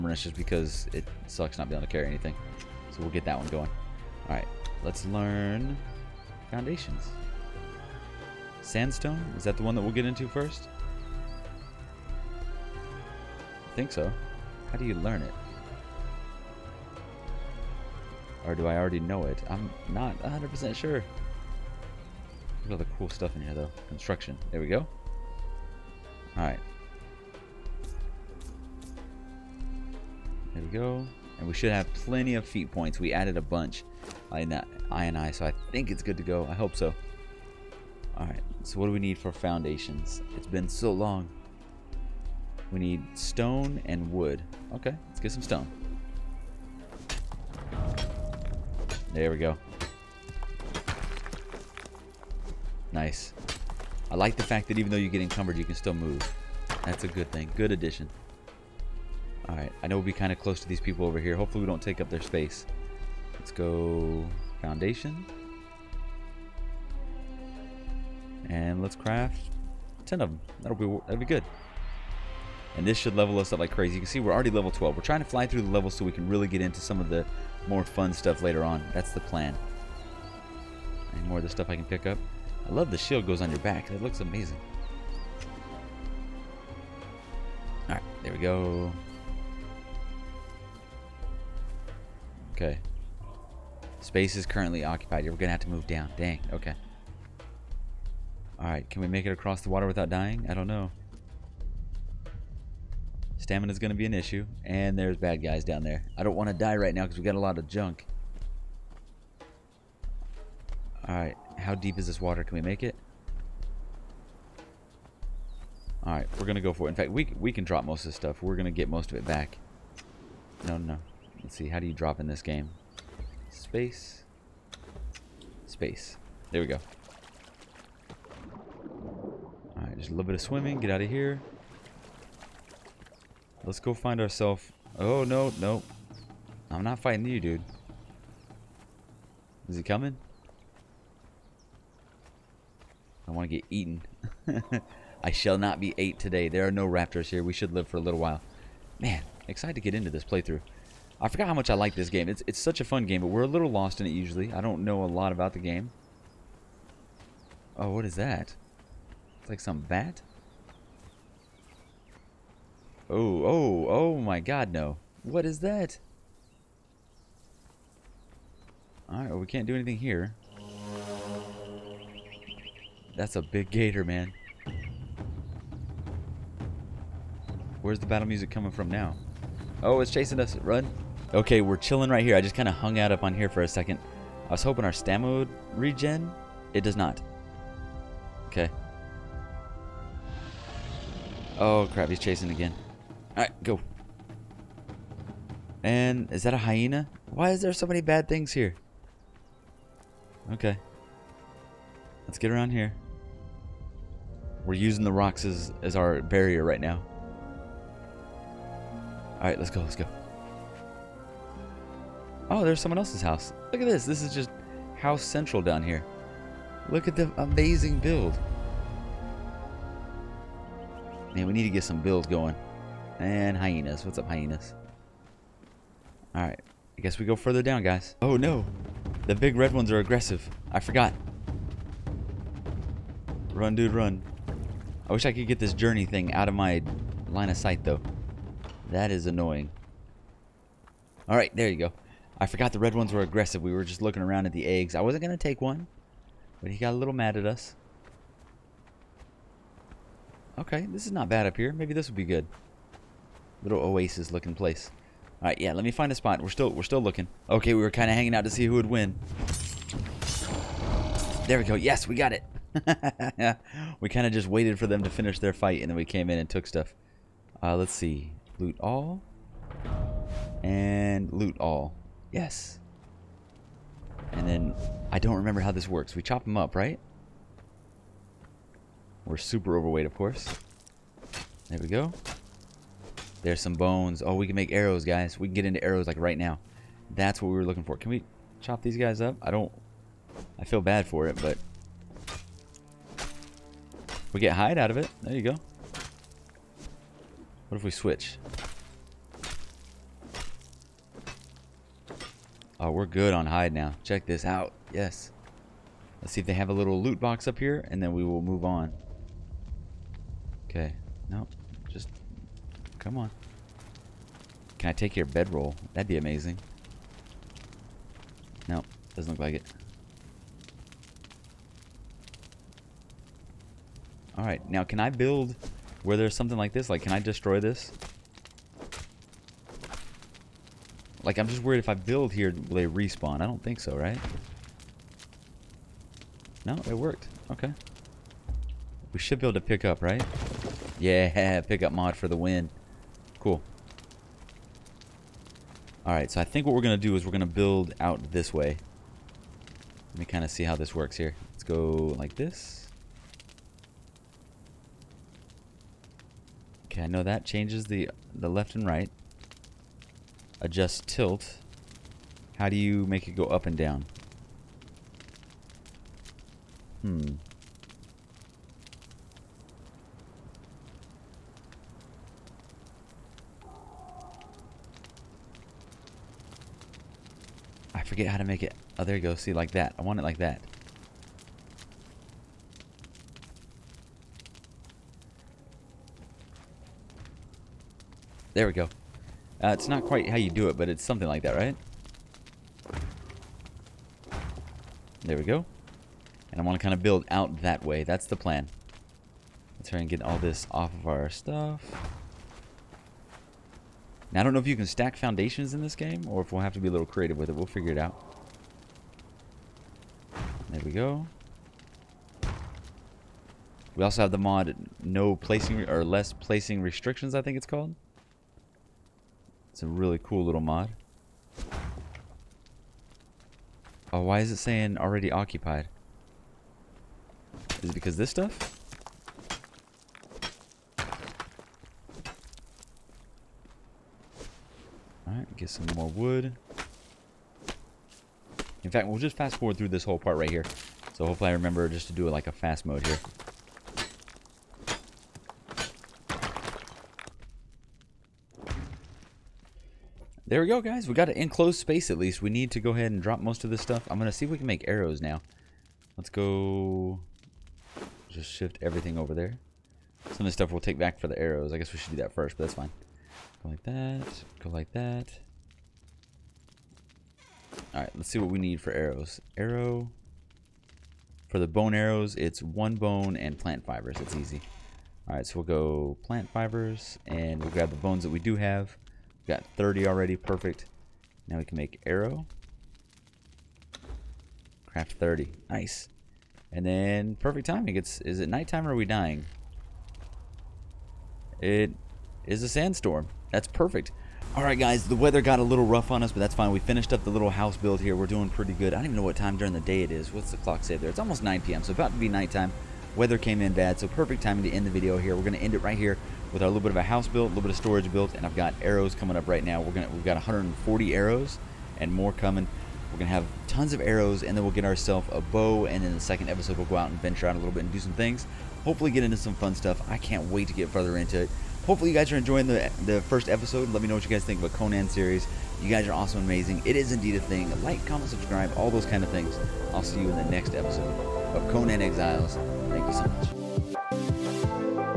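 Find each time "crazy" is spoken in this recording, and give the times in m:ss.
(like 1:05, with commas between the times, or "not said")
1:13.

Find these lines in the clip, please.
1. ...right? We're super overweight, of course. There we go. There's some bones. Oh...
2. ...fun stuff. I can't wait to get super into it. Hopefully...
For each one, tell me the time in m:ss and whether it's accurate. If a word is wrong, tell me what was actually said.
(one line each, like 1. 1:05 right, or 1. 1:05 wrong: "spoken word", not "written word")
1. 4:36 right
2. 8:39 wrong: "further", not "super".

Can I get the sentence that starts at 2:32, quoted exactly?
It's, it's such a fun game, but we're a little lost in it usually.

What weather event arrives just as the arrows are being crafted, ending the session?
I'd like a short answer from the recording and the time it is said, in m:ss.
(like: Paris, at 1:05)
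Sandstorm, at 8:12.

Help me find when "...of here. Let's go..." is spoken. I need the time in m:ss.
2:11.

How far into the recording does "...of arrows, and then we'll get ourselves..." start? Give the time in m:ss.
8:33.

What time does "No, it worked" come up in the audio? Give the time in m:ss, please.
5:36.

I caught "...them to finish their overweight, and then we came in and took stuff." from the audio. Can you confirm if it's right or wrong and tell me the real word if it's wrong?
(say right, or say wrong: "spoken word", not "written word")
wrong: "fight", not "overweight".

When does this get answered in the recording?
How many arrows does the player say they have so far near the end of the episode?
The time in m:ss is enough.
8:30.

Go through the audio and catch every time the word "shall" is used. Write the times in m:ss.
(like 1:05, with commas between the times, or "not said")
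2:25.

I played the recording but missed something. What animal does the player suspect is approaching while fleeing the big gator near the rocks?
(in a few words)
Hyena.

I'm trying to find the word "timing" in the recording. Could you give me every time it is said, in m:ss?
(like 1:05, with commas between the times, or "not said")
8:07, 8:24.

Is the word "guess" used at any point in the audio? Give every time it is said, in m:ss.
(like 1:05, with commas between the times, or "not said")
3:47, 7:41.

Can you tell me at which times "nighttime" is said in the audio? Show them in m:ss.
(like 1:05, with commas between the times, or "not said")
8:08, 8:22.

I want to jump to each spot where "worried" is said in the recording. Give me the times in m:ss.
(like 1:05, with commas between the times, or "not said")
5:31.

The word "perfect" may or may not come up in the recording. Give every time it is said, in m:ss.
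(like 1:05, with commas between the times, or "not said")
8:00, 8:07, 8:13, 8:24.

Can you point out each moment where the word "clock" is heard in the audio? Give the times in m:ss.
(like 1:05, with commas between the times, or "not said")
8:20.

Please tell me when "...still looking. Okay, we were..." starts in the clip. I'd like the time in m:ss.
4:16.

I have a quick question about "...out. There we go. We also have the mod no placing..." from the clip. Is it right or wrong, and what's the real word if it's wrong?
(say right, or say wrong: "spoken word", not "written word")
right.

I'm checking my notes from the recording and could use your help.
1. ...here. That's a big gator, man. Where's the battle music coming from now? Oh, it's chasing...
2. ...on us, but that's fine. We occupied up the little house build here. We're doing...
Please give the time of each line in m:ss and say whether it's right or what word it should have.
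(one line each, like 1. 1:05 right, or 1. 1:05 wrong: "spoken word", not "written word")
1. 2:49 right
2. 8:16 wrong: "finished", not "occupied".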